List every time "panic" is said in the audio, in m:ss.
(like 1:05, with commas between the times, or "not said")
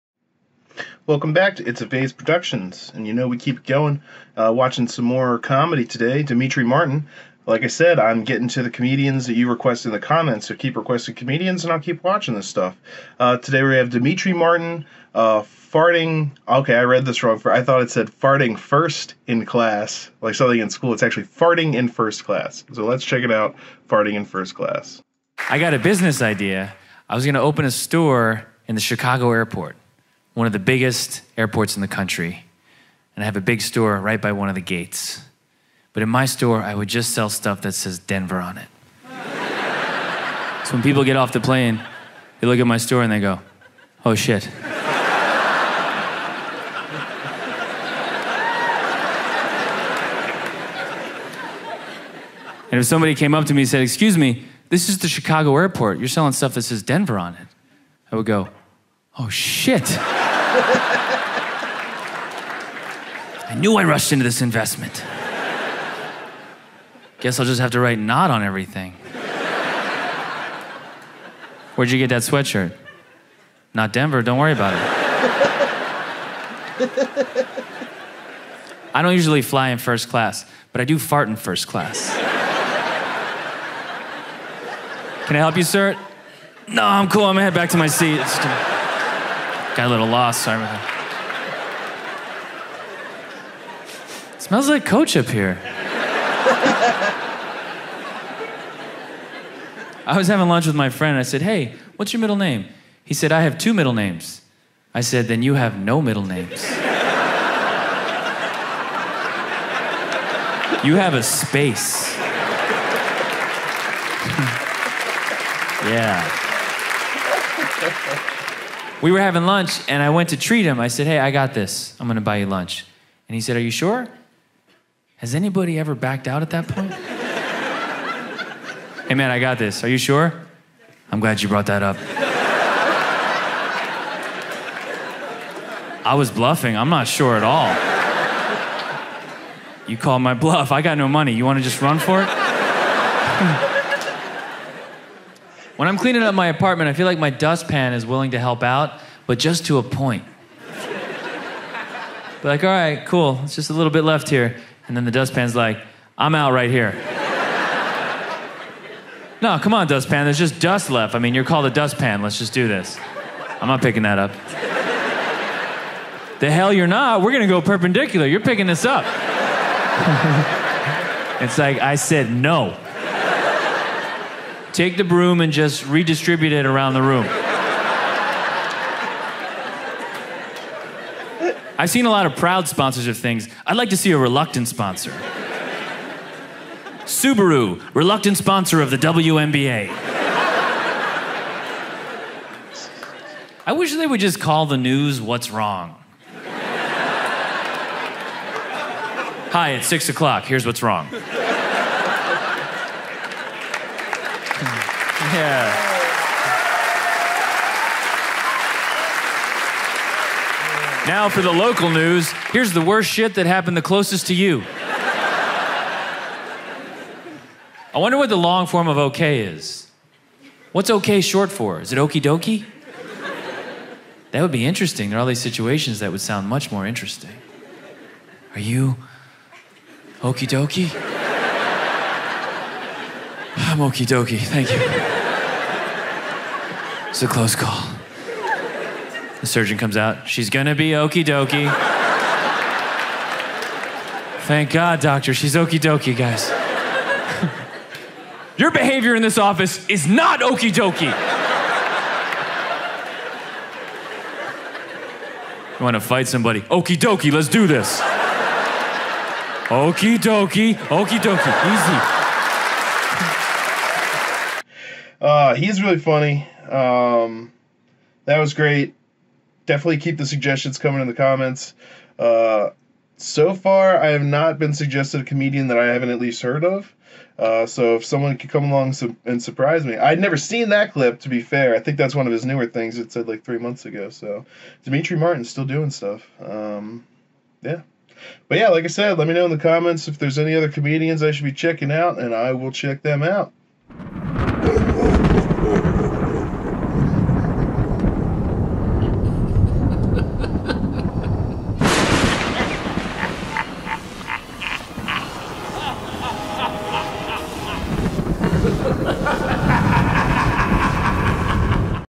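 not said.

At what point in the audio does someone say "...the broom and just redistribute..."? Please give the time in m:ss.
2:54.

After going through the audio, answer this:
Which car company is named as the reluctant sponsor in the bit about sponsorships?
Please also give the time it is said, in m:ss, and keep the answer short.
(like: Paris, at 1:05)
Subaru, at 3:07.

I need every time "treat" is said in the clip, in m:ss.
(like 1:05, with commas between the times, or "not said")
2:00.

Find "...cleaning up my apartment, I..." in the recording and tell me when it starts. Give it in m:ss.
2:25.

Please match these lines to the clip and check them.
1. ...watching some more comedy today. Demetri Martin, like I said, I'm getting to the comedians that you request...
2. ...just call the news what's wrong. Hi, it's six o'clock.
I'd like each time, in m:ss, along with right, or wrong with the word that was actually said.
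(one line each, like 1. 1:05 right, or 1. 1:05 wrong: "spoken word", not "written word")
1. 0:04 right
2. 3:14 right.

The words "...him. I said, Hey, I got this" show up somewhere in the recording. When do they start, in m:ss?
2:00.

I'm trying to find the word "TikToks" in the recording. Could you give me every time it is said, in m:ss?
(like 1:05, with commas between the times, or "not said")
not said.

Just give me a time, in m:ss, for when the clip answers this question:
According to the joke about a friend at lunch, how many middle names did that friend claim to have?
1:43.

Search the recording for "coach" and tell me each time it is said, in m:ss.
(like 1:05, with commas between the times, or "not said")
1:34.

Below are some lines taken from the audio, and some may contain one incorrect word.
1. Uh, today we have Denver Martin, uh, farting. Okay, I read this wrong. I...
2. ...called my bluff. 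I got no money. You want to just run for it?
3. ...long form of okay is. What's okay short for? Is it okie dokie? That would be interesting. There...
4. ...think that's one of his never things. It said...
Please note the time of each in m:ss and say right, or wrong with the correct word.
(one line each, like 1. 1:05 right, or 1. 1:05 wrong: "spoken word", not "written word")
1. 0:13 wrong: "Demetri", not "Denver"
2. 2:19 right
3. 3:38 right
4. 4:41 wrong: "newer", not "never".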